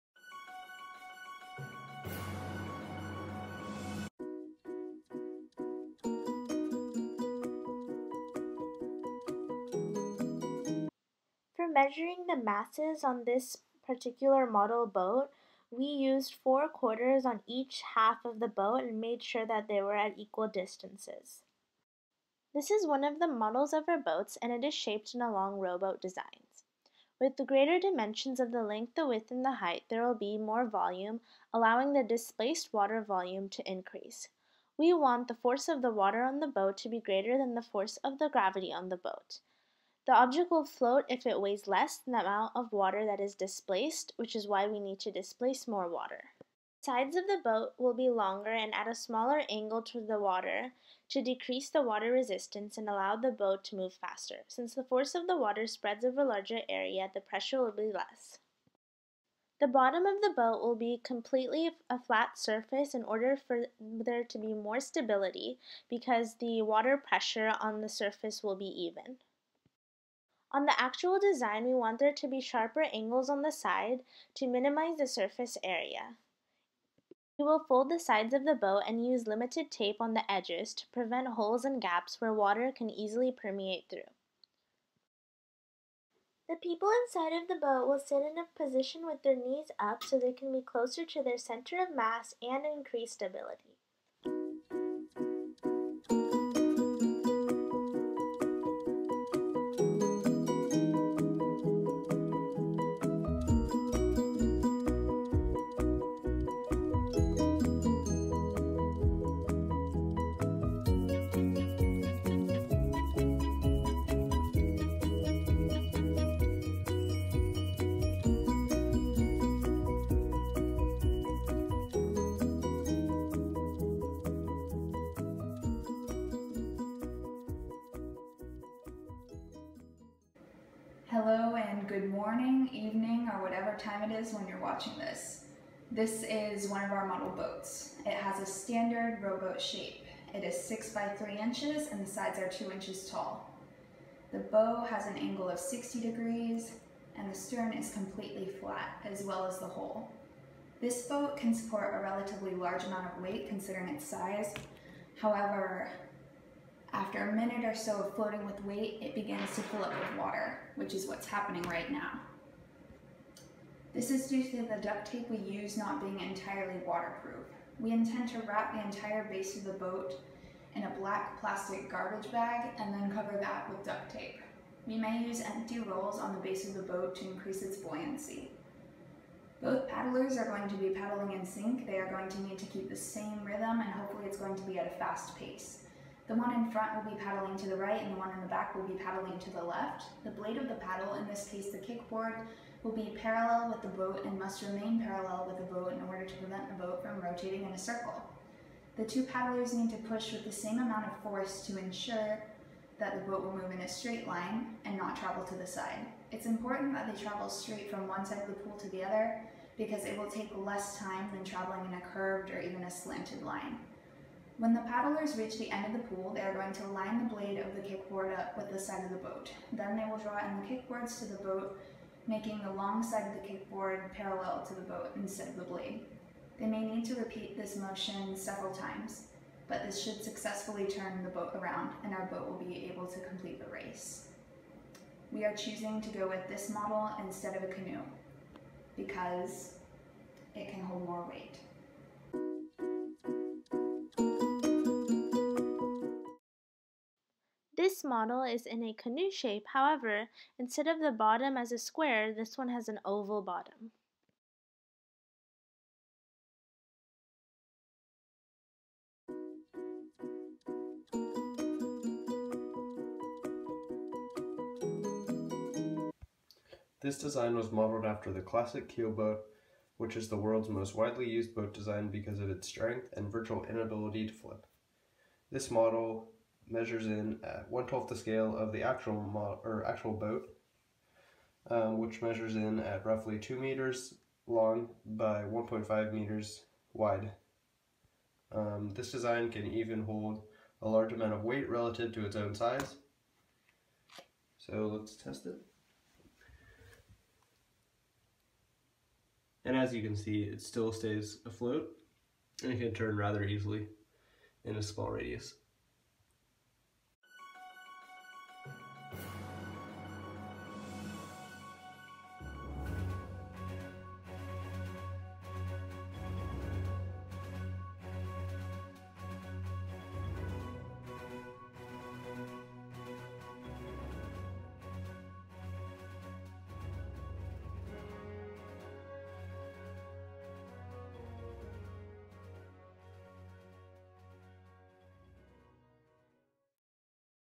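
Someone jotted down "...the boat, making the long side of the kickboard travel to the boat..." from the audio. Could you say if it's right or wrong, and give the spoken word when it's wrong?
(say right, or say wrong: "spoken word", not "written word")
wrong: "parallel", not "travel".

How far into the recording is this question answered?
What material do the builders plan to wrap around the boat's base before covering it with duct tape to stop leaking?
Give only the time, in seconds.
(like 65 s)
170 s.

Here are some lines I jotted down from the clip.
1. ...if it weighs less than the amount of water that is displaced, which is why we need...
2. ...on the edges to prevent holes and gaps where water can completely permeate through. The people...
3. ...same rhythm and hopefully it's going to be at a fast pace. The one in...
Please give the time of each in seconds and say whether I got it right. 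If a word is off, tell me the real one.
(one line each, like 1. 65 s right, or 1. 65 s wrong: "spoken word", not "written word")
1. 41 s right
2. 80 s wrong: "easily", not "completely"
3. 182 s right.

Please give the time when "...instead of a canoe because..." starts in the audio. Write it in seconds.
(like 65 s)
237 s.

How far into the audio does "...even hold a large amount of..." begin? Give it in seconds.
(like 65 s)
289 s.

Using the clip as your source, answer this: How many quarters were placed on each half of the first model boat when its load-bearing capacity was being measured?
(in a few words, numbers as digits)
4.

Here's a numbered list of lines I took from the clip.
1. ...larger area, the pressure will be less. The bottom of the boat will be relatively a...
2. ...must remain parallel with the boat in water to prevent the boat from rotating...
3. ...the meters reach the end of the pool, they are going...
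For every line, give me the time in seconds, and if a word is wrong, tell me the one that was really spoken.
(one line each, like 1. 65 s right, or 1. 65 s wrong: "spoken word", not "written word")
1. 56 s wrong: "completely", not "relatively"
2. 194 s wrong: "order", not "water"
3. 214 s wrong: "paddlers", not "meters".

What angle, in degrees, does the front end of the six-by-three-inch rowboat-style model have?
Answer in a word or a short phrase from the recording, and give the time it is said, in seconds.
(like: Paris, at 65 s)
60 degrees, at 145 s.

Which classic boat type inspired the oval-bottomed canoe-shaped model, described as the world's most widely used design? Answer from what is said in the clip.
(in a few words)
keelboat.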